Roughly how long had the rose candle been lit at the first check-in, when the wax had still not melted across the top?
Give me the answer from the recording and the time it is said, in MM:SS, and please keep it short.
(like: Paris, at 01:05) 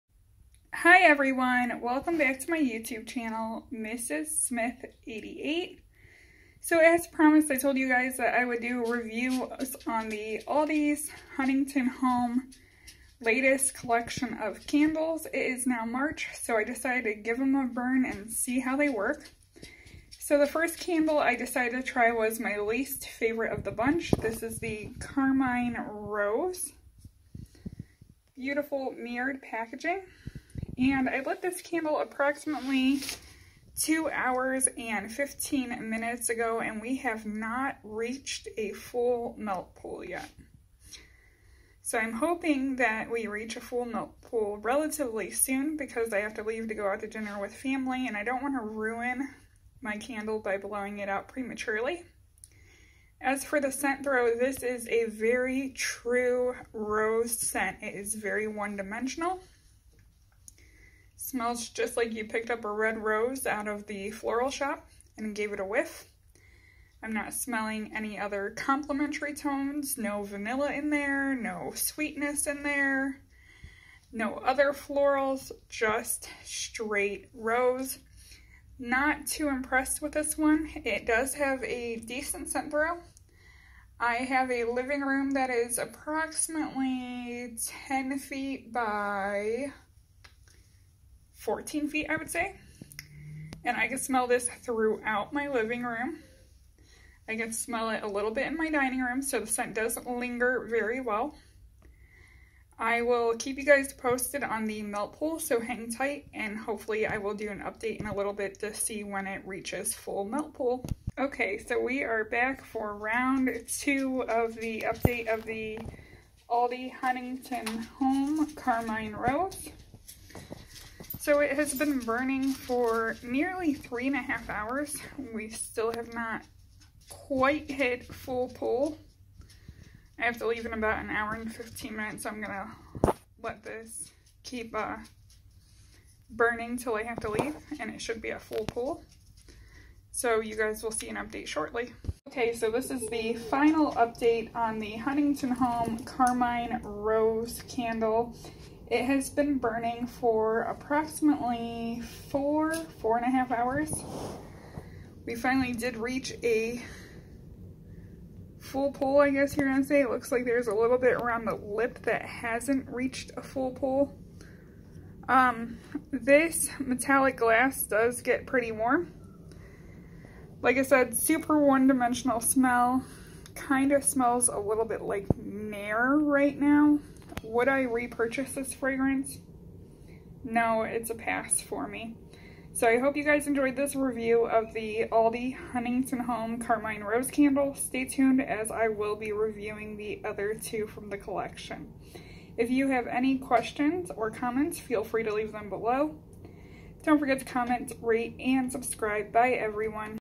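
2 hours 15 minutes, at 00:33.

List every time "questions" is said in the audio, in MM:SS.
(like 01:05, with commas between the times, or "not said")
03:13.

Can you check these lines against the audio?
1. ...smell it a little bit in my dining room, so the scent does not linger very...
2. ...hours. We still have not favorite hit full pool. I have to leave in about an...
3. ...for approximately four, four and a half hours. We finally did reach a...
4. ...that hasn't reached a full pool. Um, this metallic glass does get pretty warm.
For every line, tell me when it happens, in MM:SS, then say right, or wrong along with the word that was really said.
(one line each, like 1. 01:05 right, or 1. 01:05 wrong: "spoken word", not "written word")
1. 01:37 right
2. 02:04 wrong: "quite", not "favorite"
3. 02:30 right
4. 02:42 right.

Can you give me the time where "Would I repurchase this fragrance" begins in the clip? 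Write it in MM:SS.
02:57.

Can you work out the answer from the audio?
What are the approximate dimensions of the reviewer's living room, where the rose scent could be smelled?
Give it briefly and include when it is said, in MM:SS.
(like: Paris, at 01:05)
10 by 14 feet, at 01:27.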